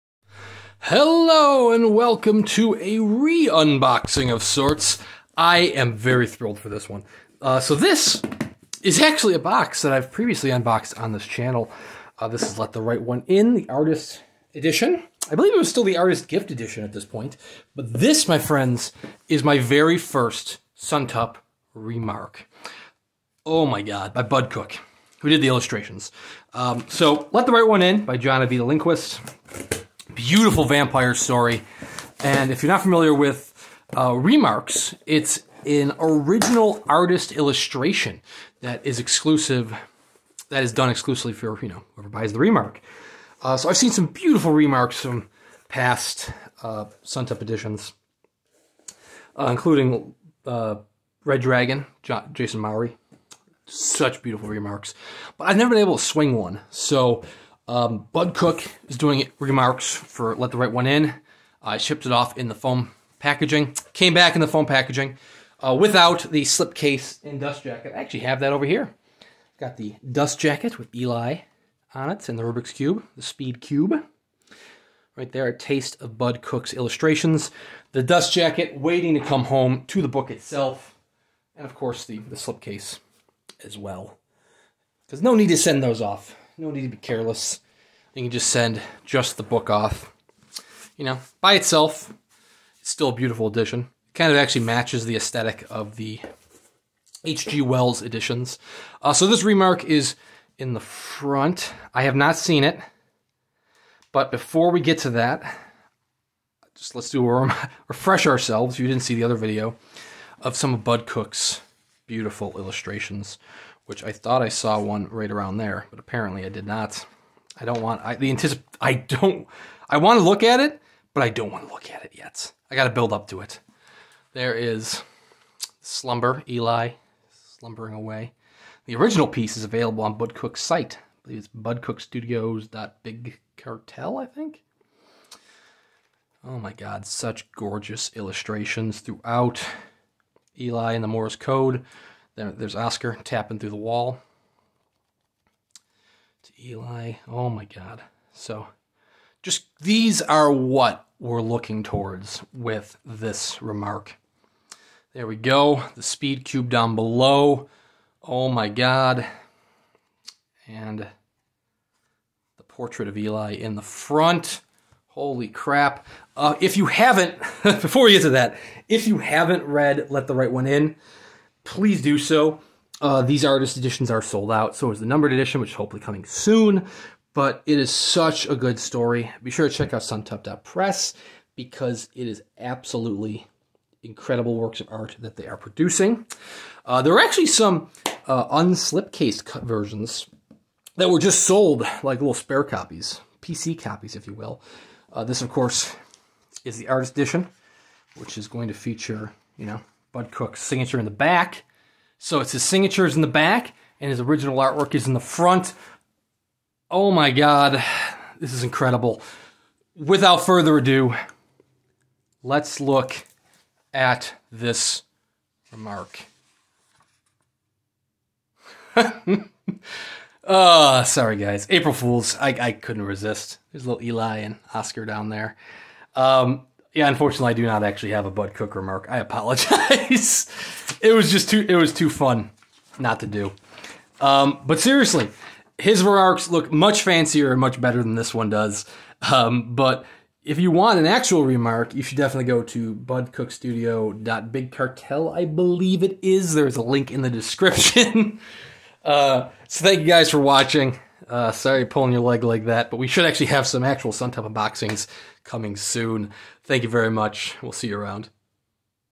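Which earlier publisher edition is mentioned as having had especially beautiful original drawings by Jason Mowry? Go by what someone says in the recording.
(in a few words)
Red Dragon.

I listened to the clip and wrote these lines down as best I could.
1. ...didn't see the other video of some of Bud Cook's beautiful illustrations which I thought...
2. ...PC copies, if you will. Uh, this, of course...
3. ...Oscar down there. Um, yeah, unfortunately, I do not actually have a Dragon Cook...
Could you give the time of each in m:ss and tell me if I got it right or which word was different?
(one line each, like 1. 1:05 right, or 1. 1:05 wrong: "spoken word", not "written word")
1. 1:48 right
2. 3:13 right
3. 3:44 wrong: "Bud", not "Dragon".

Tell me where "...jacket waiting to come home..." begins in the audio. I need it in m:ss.
1:18.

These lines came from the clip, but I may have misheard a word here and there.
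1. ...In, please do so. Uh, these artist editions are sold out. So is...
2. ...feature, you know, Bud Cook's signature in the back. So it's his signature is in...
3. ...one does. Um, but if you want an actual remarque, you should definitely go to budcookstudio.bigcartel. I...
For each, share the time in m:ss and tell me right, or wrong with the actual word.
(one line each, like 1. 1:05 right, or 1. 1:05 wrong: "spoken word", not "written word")
1. 2:50 right
2. 3:18 right
3. 3:58 right.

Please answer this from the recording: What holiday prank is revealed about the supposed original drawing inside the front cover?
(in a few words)
April Fools.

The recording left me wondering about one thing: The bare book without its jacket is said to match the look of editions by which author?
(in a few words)
H.G. Wells.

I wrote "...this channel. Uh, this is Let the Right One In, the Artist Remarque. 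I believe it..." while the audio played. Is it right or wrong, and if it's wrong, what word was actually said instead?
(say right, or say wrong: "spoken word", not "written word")
wrong: "Edition", not "Remarque".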